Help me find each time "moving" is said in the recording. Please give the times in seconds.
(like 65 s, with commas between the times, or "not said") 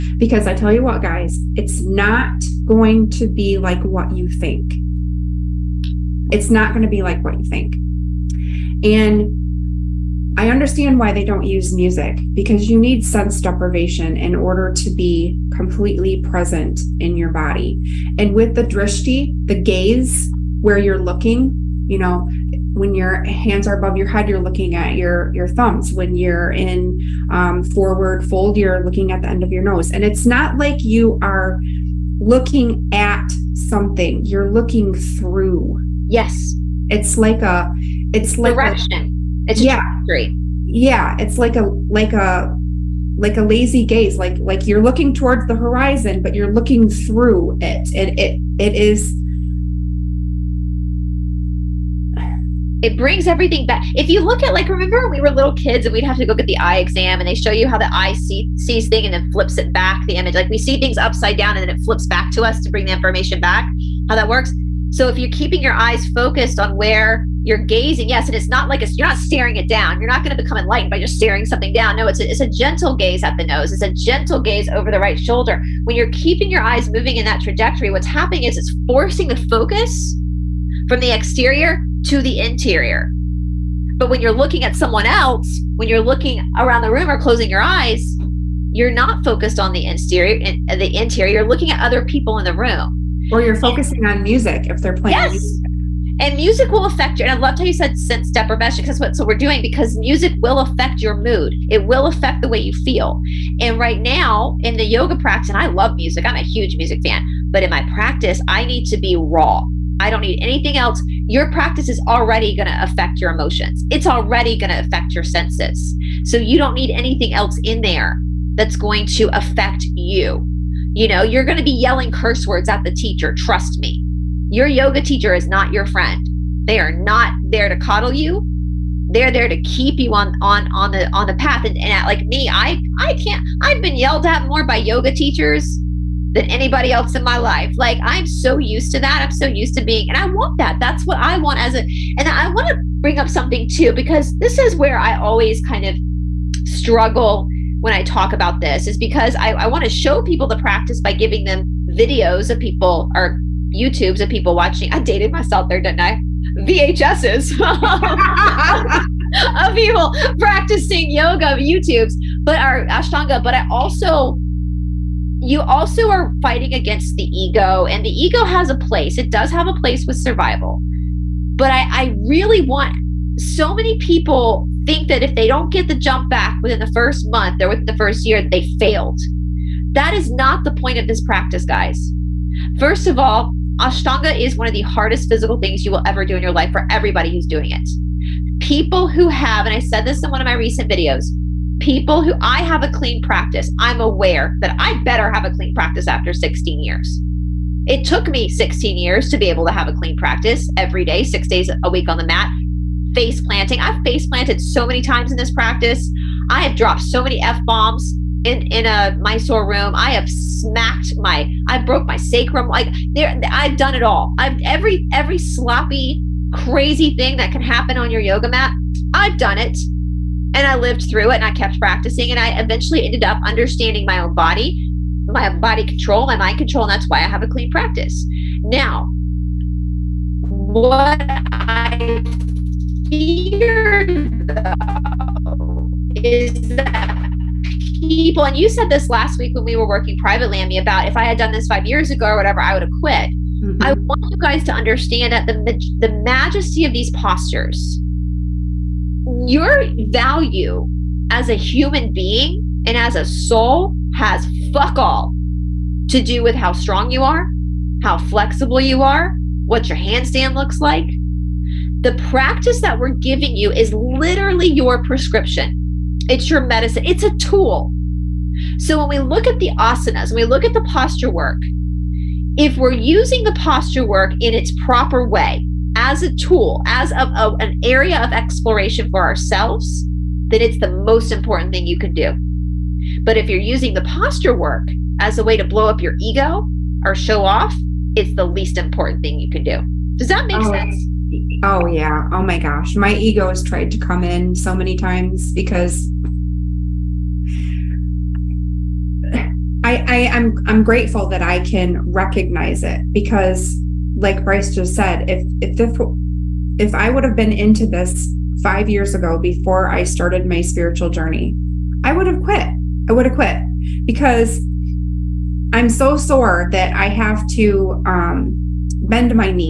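76 s.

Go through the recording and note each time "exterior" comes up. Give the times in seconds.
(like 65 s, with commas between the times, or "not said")
81 s, 89 s.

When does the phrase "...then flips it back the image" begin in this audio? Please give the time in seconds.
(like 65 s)
59 s.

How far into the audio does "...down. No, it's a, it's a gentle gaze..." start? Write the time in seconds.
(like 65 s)
71 s.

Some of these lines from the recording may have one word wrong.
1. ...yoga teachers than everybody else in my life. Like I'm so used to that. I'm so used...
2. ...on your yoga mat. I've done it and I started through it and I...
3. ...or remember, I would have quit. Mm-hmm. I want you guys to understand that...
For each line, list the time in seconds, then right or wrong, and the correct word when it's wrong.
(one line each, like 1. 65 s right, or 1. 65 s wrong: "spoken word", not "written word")
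1. 134 s wrong: "anybody", not "everybody"
2. 217 s wrong: "lived", not "started"
3. 242 s wrong: "whatever", not "remember".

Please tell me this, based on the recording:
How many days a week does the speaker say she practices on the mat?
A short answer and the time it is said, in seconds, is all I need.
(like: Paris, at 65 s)
6, at 201 s.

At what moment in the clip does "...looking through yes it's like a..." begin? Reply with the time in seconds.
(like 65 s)
34 s.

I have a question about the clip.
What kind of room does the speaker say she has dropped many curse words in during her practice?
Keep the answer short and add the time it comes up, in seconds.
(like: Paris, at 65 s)
Mysore room, at 209 s.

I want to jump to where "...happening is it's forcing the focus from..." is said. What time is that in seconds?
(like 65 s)
78 s.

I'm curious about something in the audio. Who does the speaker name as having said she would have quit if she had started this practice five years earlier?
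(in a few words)
Brice.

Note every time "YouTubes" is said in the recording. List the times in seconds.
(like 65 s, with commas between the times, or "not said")
153 s, 161 s.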